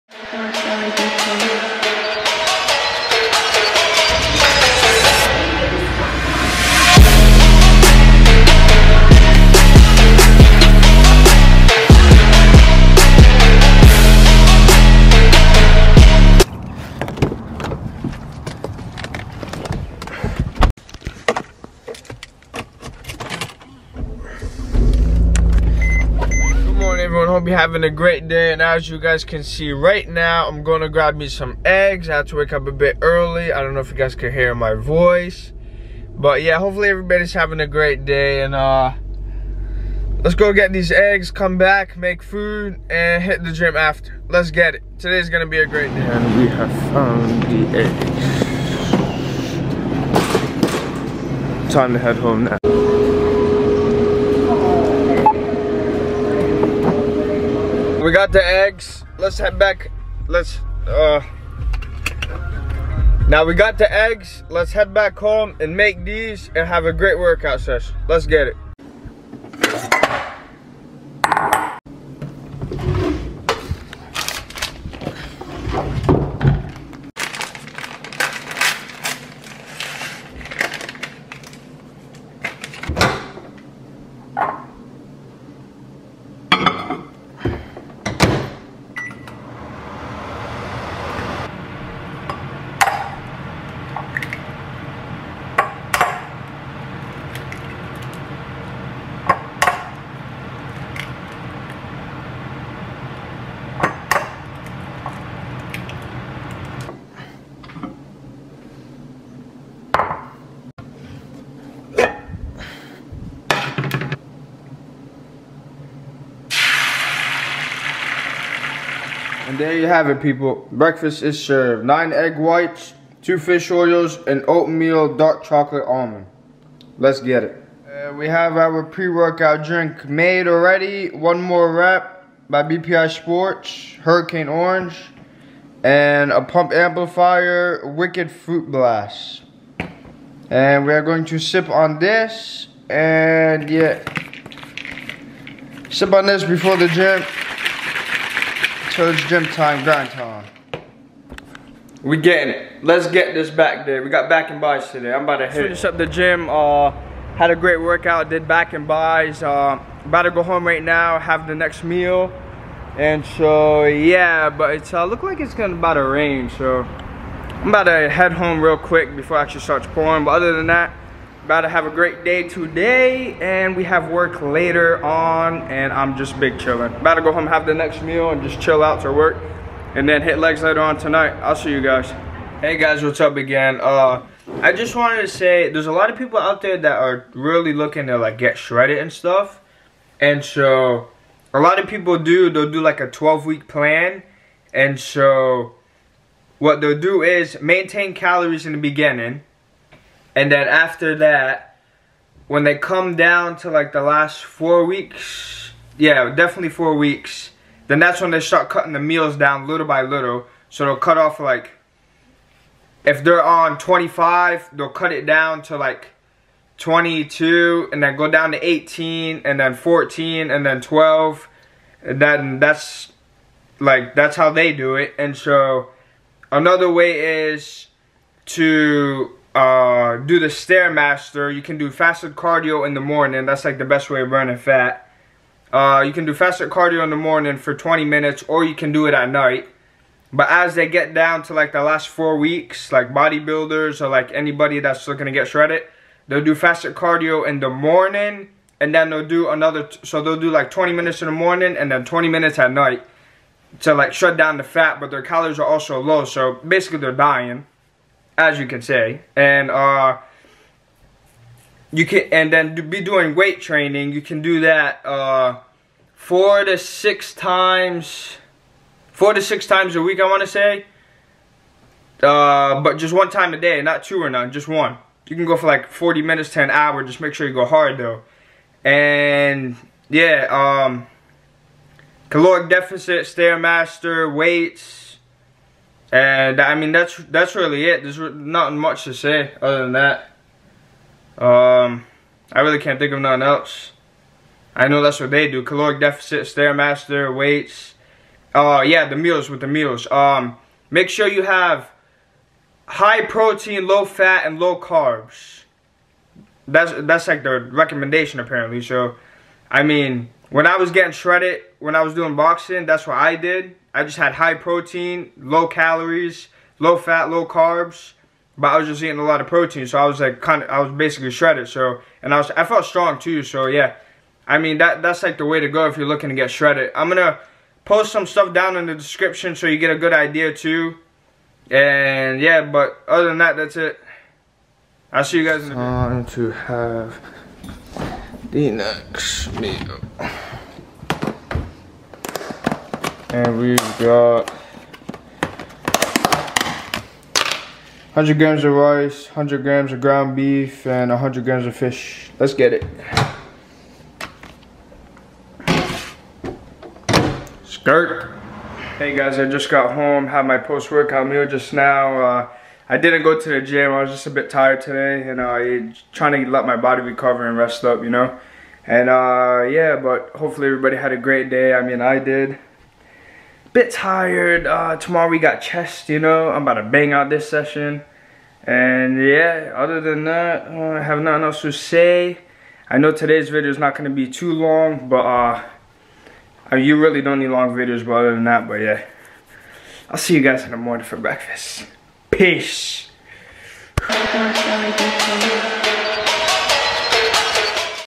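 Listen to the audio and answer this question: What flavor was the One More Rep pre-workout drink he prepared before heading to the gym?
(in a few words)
Hurricane Orange.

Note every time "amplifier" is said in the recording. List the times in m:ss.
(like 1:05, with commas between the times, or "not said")
2:16.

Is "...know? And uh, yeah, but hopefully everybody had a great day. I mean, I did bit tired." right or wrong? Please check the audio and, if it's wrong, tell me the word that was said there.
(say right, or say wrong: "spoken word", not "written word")
right.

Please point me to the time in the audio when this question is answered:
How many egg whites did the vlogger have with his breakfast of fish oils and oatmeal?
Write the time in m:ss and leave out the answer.
2:01.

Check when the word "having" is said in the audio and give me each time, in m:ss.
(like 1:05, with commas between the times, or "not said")
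0:27, 0:37.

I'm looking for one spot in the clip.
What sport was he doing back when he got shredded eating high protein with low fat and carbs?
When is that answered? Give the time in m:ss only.
5:12.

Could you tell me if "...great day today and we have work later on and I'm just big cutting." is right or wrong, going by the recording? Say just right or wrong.
wrong.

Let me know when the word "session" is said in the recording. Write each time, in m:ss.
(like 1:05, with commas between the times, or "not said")
1:07, 6:17.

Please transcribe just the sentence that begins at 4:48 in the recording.
There's not much to say other than that.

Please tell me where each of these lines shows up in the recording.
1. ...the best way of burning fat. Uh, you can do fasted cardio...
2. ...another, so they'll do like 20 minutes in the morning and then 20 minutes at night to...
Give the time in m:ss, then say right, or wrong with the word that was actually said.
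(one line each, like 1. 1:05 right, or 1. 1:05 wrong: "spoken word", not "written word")
1. 3:53 right
2. 4:09 right.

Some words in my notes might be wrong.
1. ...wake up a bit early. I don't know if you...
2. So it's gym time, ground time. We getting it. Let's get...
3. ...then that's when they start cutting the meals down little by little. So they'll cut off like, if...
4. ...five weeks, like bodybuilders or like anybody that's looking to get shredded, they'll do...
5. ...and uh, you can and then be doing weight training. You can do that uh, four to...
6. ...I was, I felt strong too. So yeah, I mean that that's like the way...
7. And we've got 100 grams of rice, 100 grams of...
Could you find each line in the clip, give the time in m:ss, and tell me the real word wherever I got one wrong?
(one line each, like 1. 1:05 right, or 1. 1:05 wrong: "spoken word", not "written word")
1. 0:32 right
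2. 2:28 wrong: "grind", not "ground"
3. 3:27 right
4. 4:02 wrong: "four", not "five"
5. 4:19 right
6. 5:22 right
7. 5:43 right.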